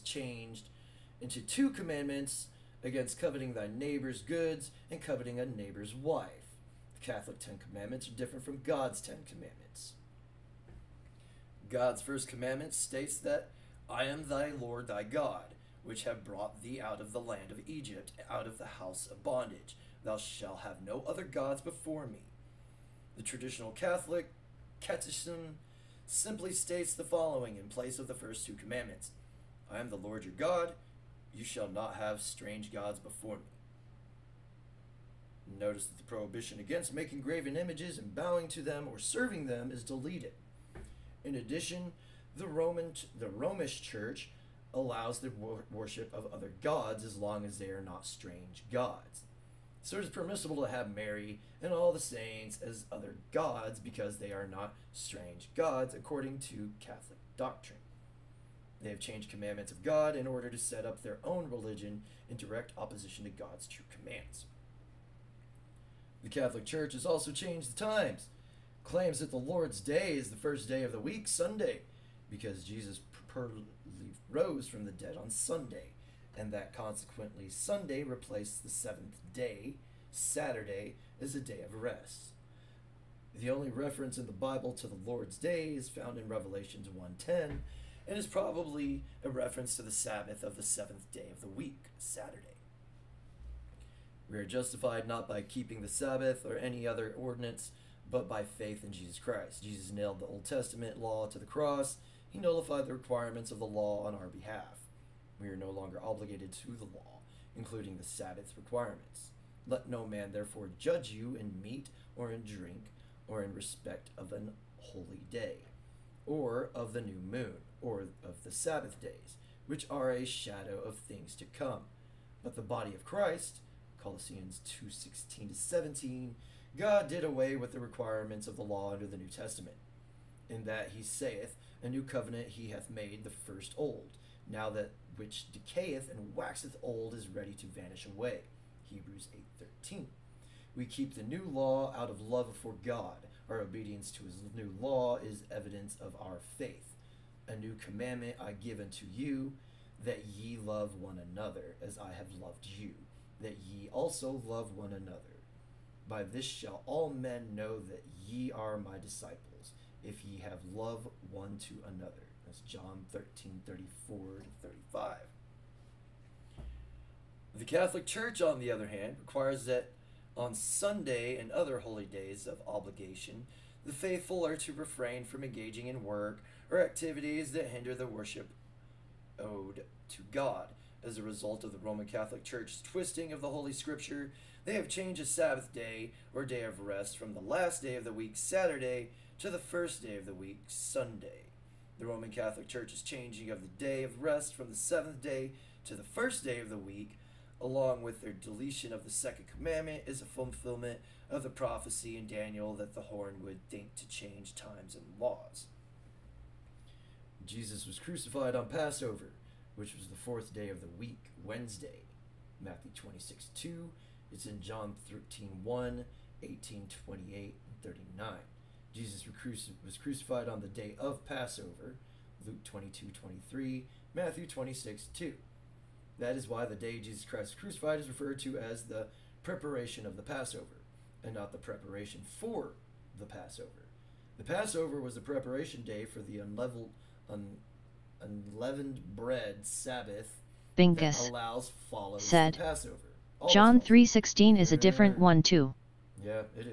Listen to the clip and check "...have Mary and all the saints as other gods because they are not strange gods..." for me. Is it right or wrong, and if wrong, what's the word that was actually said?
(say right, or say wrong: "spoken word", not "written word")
right.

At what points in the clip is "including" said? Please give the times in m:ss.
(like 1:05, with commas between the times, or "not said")
1:47.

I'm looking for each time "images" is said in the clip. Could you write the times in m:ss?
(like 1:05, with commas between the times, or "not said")
0:37.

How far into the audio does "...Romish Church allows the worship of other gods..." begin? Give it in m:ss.
0:43.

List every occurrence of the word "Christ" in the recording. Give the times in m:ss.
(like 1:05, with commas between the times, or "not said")
1:39, 2:03, 3:47.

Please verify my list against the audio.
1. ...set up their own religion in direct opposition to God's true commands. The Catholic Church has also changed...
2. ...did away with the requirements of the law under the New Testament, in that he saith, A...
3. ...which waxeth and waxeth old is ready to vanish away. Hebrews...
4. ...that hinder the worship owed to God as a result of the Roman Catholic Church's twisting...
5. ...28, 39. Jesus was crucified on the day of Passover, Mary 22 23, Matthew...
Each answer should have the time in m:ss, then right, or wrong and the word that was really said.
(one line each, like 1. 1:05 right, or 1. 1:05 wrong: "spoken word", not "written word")
1. 1:00 right
2. 2:07 right
3. 2:15 wrong: "decayeth", not "waxeth"
4. 2:57 right
5. 3:37 wrong: "Luke", not "Mary".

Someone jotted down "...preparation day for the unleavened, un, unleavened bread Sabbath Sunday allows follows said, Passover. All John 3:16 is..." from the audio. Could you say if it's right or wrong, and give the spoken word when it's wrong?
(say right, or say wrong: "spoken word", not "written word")
wrong: "Bingus", not "Sunday".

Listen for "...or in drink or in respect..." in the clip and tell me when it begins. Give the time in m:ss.
1:52.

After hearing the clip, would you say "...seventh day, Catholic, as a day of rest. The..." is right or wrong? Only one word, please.
wrong.